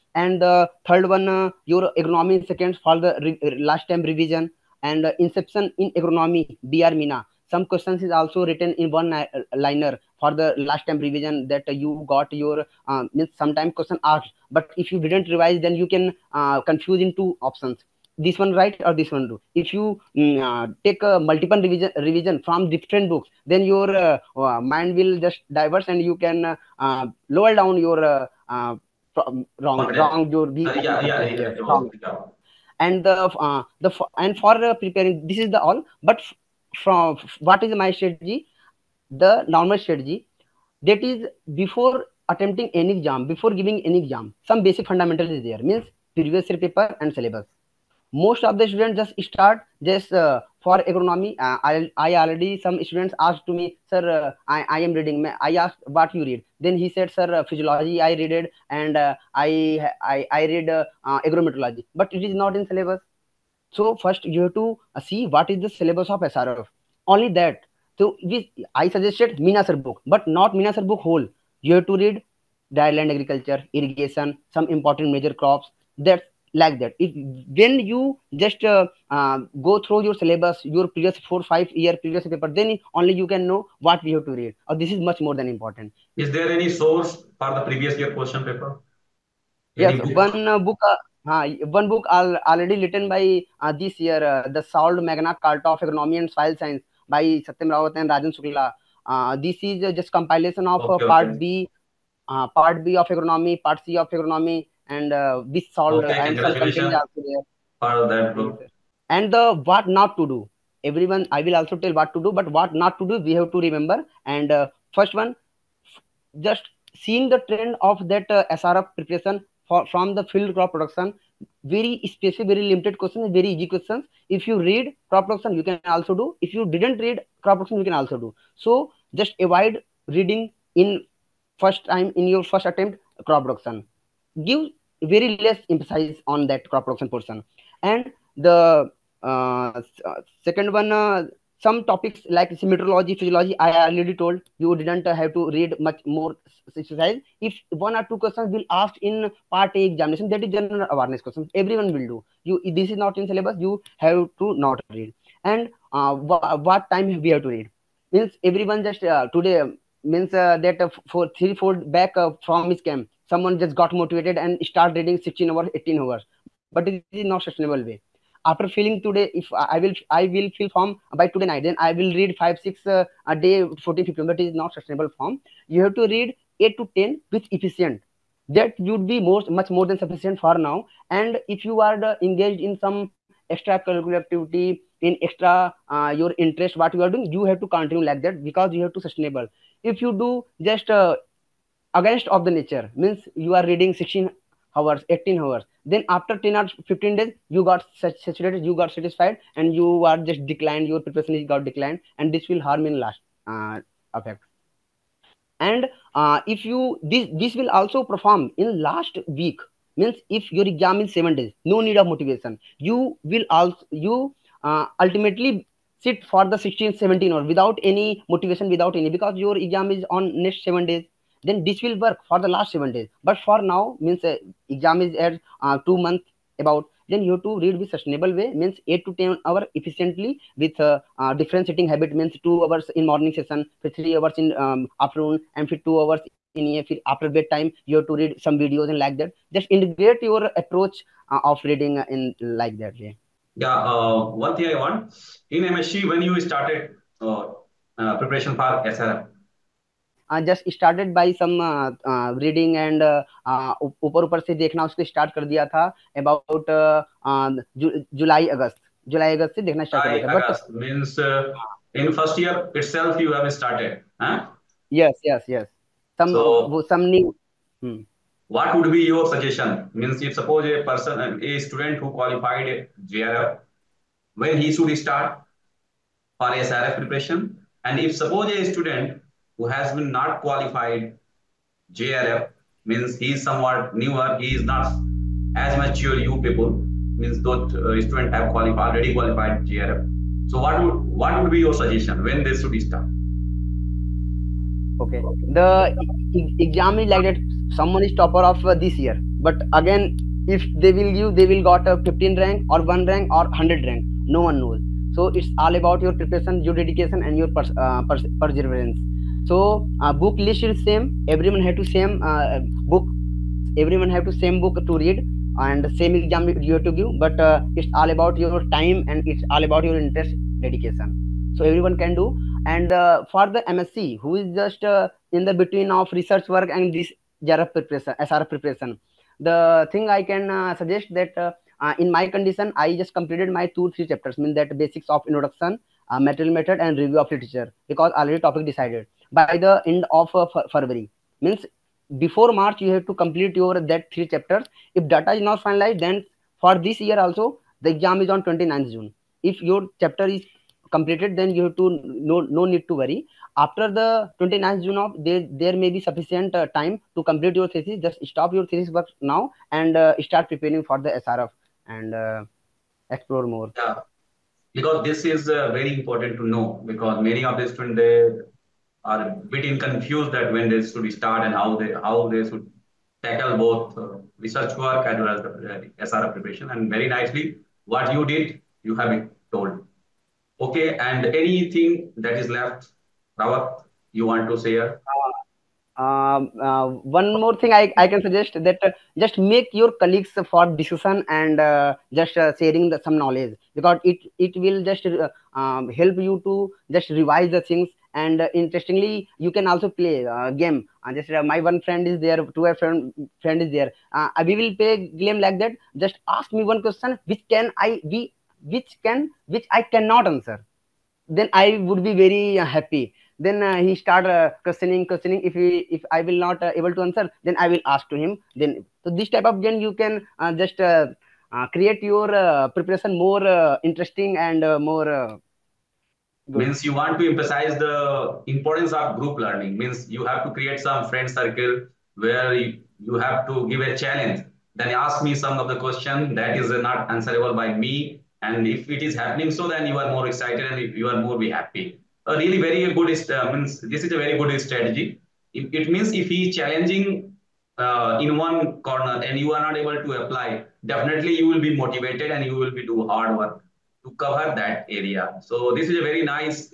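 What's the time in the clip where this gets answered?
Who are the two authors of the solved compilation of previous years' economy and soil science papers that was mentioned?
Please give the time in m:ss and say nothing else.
1:37.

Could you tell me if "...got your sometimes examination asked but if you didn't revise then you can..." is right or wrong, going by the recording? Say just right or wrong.
wrong.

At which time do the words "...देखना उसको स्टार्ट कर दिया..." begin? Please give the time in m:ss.
4:14.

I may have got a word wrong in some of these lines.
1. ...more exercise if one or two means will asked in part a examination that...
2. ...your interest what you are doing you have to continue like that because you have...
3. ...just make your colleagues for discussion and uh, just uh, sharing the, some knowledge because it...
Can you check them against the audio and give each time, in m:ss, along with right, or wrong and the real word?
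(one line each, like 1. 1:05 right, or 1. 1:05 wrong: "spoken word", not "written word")
1. 2:26 wrong: "questions", not "means"
2. 3:06 right
3. 6:29 right.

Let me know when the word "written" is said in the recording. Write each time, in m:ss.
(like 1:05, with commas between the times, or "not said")
0:08, 1:32.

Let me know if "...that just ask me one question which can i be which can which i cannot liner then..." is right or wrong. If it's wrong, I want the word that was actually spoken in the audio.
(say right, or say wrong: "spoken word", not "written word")
wrong: "answer", not "liner".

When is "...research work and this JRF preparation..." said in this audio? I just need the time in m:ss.
5:26.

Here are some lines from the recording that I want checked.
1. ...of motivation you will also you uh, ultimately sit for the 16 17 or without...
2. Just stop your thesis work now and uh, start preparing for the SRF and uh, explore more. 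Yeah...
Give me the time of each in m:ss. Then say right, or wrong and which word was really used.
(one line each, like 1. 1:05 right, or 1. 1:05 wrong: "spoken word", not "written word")
1. 3:31 right
2. 5:58 right.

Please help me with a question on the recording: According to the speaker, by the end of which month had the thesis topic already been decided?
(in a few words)
February.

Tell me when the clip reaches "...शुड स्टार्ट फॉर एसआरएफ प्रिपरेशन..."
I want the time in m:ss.
4:34.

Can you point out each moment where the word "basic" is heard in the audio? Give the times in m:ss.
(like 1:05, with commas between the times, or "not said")
0:44, 5:34.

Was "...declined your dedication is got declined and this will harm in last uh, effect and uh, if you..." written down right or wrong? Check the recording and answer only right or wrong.
wrong.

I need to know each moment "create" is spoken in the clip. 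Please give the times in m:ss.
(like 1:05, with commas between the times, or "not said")
7:01, 7:10.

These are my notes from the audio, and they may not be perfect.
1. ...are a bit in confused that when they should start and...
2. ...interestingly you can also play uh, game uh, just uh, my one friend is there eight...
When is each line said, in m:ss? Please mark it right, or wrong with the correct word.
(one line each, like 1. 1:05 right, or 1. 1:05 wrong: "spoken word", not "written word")
1. 6:09 right
2. 6:38 wrong: "two", not "eight".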